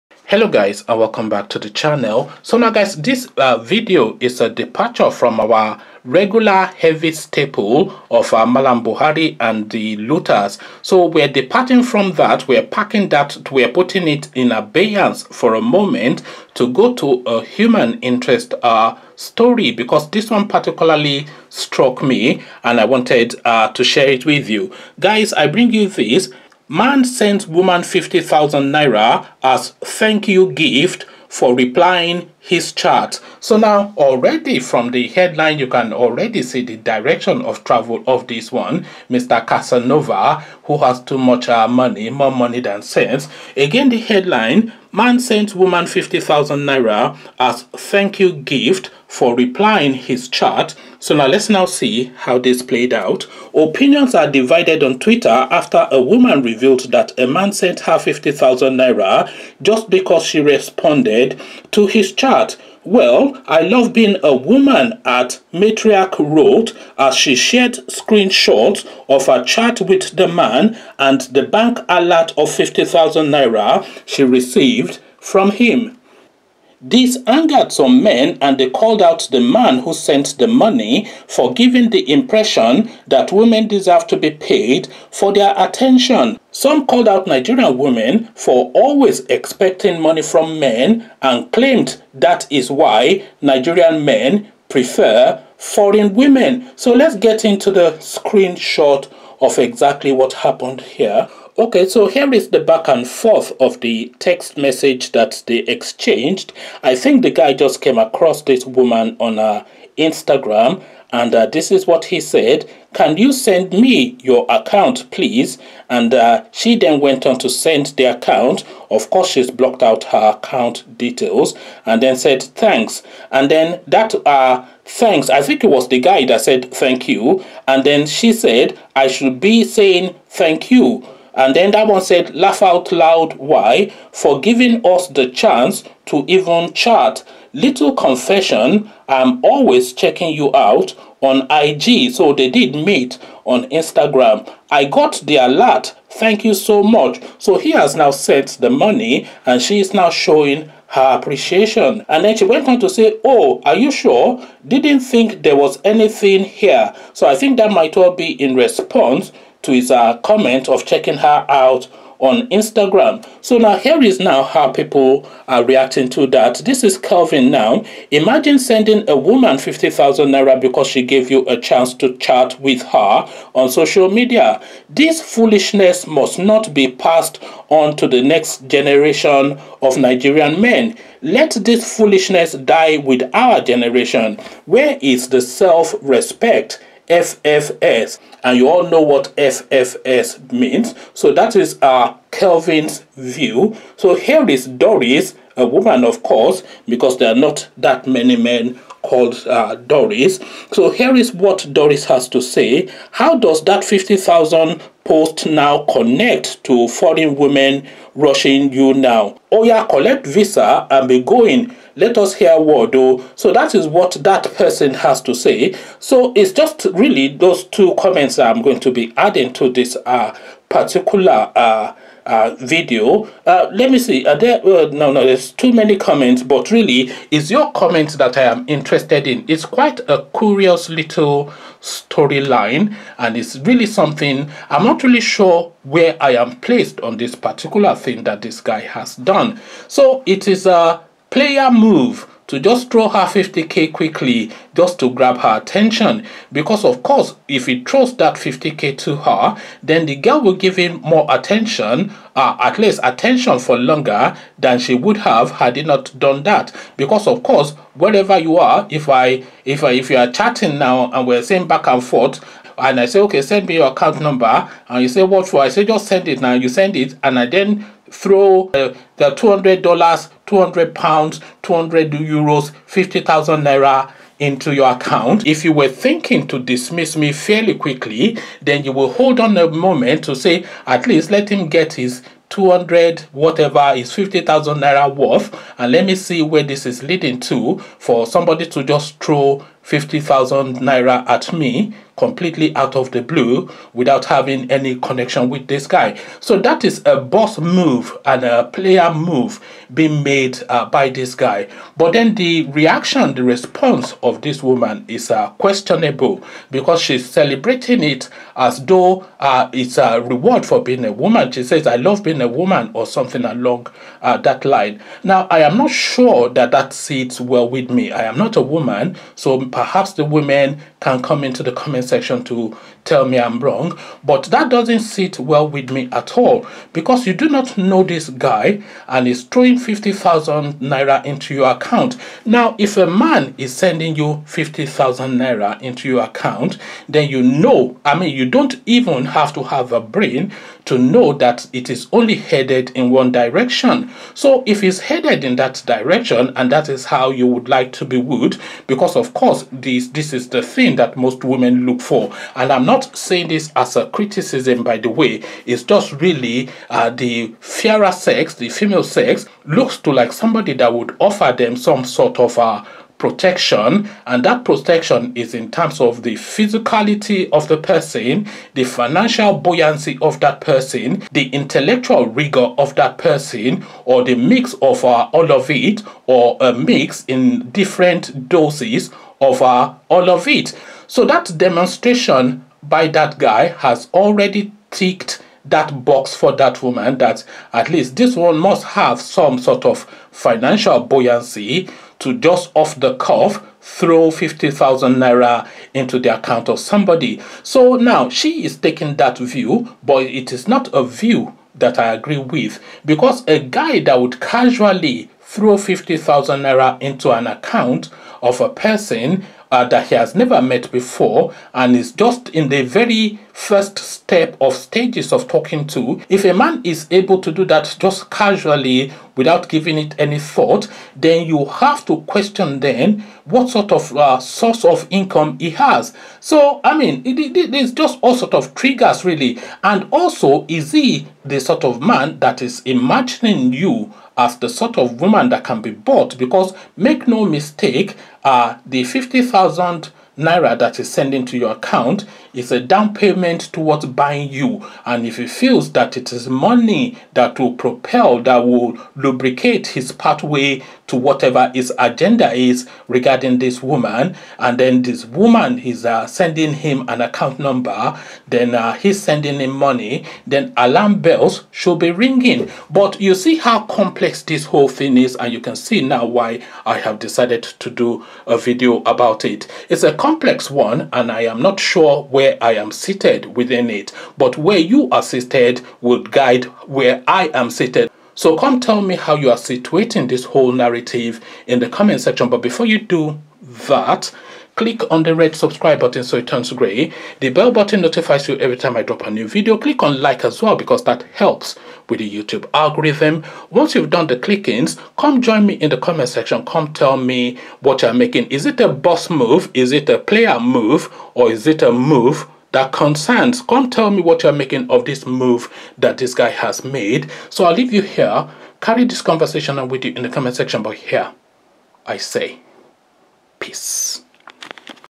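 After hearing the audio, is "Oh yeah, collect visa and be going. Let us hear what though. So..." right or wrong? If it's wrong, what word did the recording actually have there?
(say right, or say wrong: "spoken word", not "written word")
right.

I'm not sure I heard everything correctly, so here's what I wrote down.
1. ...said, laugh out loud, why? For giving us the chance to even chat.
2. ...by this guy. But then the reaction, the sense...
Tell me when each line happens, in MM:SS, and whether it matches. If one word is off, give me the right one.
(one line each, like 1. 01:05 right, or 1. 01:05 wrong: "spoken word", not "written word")
1. 02:12 right
2. 05:00 wrong: "response", not "sense".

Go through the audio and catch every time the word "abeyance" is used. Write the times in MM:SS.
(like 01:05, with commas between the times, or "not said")
00:14.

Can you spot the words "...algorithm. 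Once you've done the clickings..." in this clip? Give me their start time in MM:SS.
08:12.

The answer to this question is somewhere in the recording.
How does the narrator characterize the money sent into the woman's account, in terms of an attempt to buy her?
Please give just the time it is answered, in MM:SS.
07:22.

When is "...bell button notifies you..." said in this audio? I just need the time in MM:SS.
08:07.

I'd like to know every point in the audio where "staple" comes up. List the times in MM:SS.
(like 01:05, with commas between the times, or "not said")
00:07.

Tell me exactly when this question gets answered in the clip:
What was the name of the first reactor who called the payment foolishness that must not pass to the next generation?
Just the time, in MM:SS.
02:46.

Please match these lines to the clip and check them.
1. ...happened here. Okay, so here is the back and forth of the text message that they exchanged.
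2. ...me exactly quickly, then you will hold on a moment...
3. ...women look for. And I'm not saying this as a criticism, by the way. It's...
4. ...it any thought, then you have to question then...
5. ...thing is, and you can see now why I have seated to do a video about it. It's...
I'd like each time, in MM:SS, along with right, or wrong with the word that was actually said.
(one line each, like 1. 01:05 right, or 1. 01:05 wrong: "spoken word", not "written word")
1. 01:40 right
2. 04:37 wrong: "fairly", not "exactly"
3. 05:51 right
4. 06:59 right
5. 07:44 wrong: "decided", not "seated".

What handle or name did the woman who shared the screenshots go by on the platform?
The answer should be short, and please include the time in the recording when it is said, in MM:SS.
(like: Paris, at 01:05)
Matriarch Road, at 01:05.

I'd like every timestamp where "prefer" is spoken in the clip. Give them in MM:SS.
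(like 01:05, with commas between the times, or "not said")
01:34.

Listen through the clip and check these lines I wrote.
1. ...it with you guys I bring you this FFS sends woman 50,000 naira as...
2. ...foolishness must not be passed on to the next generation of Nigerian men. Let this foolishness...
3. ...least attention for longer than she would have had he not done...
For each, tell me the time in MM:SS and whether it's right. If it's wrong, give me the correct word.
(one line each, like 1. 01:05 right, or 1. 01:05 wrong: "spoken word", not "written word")
1. 00:24 wrong: "Man", not "FFS"
2. 02:55 right
3. 04:12 right.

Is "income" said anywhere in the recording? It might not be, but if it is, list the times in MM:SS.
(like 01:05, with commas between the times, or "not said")
07:05.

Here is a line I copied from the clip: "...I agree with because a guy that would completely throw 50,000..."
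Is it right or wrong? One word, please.
wrong.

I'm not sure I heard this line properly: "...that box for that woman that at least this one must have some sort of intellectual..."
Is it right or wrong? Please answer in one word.
wrong.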